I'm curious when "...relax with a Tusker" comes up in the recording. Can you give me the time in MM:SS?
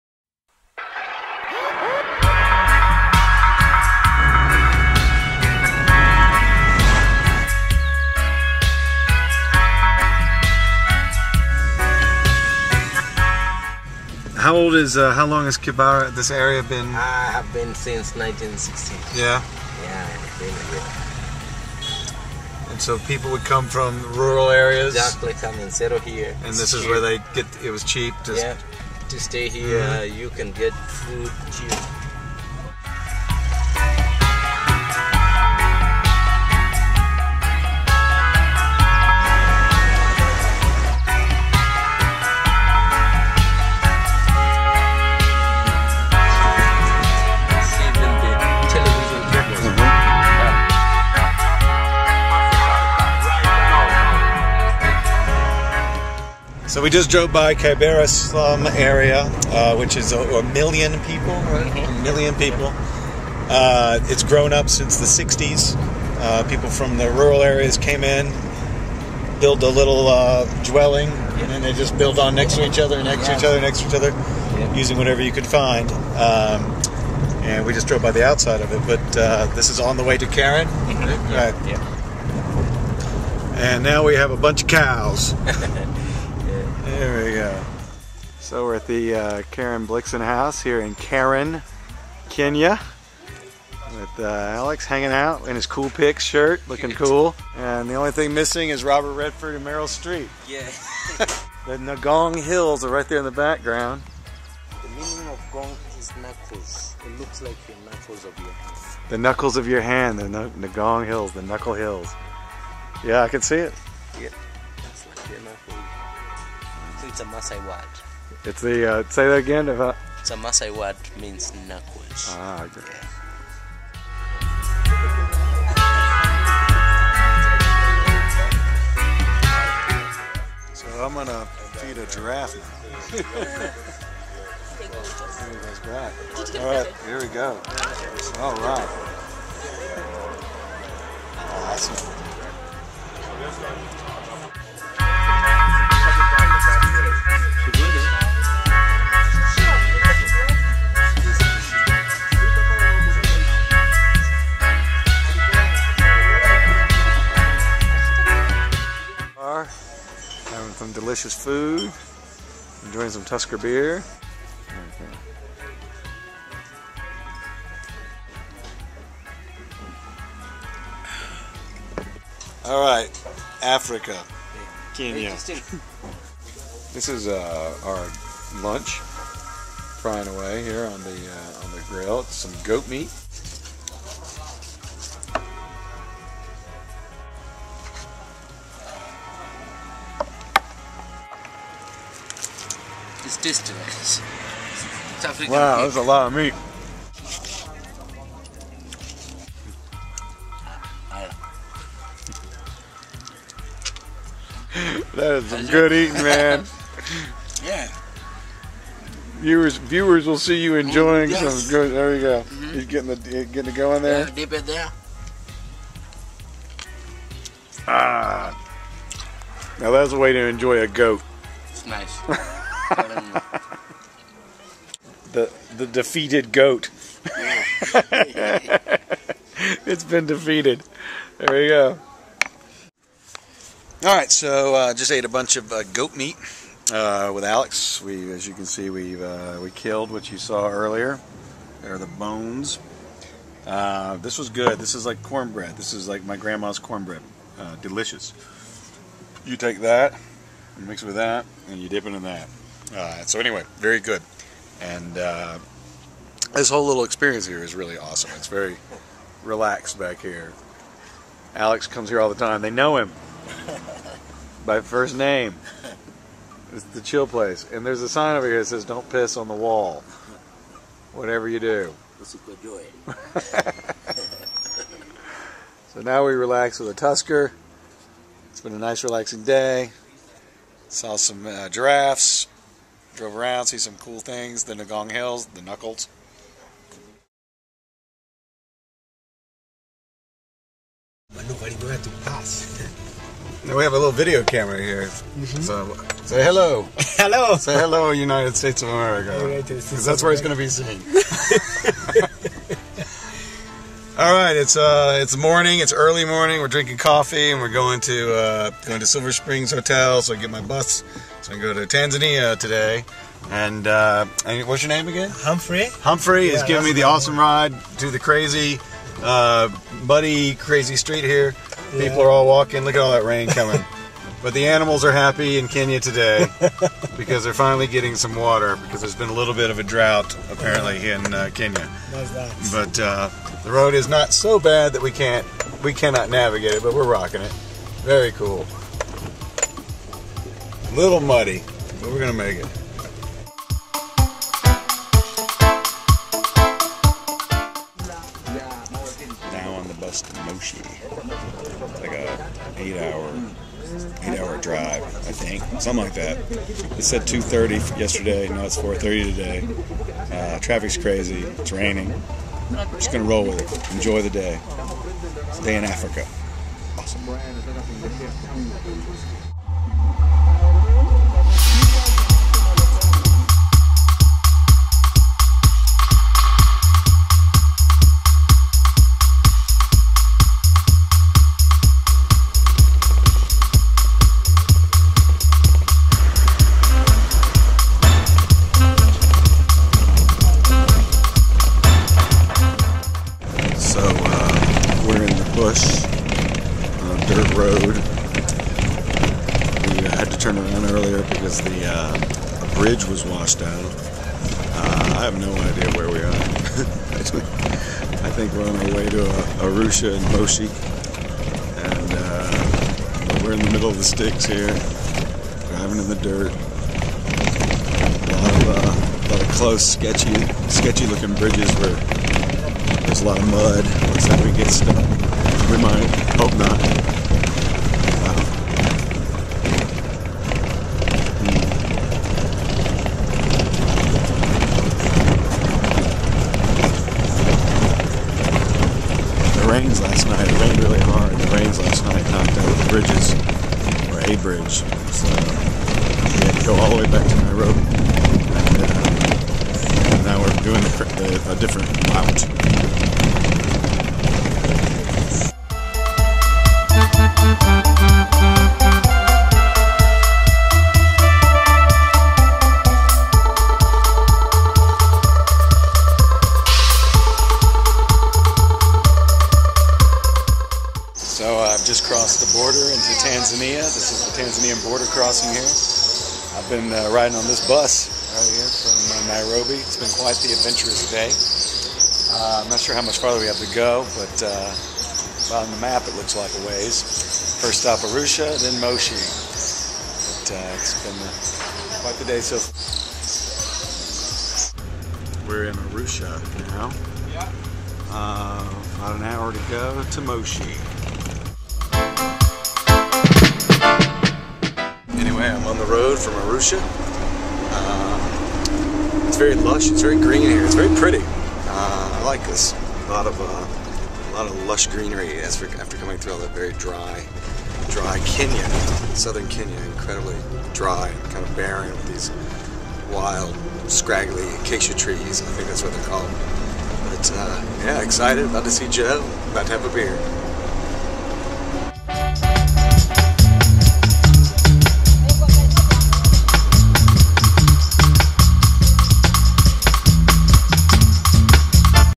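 04:36.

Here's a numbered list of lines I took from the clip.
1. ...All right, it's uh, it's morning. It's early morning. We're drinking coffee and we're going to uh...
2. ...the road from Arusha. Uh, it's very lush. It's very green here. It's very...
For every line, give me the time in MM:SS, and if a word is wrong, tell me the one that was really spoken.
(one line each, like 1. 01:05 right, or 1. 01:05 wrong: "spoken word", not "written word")
1. 05:04 right
2. 08:25 right.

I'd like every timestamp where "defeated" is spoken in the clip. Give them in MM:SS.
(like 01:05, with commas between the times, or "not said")
03:45, 03:50.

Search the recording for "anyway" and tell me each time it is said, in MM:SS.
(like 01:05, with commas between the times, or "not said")
04:13, 08:25.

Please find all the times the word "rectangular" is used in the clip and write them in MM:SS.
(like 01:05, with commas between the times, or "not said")
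not said.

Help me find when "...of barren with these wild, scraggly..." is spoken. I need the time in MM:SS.
08:41.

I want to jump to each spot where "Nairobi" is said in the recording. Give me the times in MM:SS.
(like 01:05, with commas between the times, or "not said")
07:27, 07:59.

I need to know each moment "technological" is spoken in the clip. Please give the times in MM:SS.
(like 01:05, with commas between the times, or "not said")
not said.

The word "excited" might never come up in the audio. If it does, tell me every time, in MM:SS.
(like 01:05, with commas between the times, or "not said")
08:48.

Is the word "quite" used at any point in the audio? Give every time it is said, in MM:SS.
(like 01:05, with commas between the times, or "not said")
08:00, 08:12.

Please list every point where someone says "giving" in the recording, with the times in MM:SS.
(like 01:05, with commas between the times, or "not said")
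05:16.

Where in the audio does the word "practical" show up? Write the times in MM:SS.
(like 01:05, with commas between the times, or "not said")
not said.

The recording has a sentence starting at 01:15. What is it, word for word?
Um, and we just drove by the outside of it, but uh, this is on the way to Karen.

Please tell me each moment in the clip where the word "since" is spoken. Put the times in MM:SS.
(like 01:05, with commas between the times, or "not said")
00:17, 01:04.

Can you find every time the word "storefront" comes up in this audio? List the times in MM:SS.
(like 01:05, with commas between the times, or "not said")
not said.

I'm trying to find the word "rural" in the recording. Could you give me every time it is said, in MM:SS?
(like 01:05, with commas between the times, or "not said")
00:24, 01:07.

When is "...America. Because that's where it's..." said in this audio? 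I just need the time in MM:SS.
04:58.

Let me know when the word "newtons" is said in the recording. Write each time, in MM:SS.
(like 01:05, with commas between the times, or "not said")
not said.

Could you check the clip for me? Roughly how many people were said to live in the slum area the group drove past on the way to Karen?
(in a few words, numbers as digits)
a million.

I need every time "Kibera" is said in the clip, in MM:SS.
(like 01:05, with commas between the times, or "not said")
00:15, 00:57.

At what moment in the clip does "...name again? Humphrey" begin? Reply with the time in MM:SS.
05:14.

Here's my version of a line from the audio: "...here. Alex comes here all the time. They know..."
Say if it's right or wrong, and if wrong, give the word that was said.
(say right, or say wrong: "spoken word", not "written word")
right.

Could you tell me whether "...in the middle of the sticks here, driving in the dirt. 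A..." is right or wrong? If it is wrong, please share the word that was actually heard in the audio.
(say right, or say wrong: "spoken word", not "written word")
right.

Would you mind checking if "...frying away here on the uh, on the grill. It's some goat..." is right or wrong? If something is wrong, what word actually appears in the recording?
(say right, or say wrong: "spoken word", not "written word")
right.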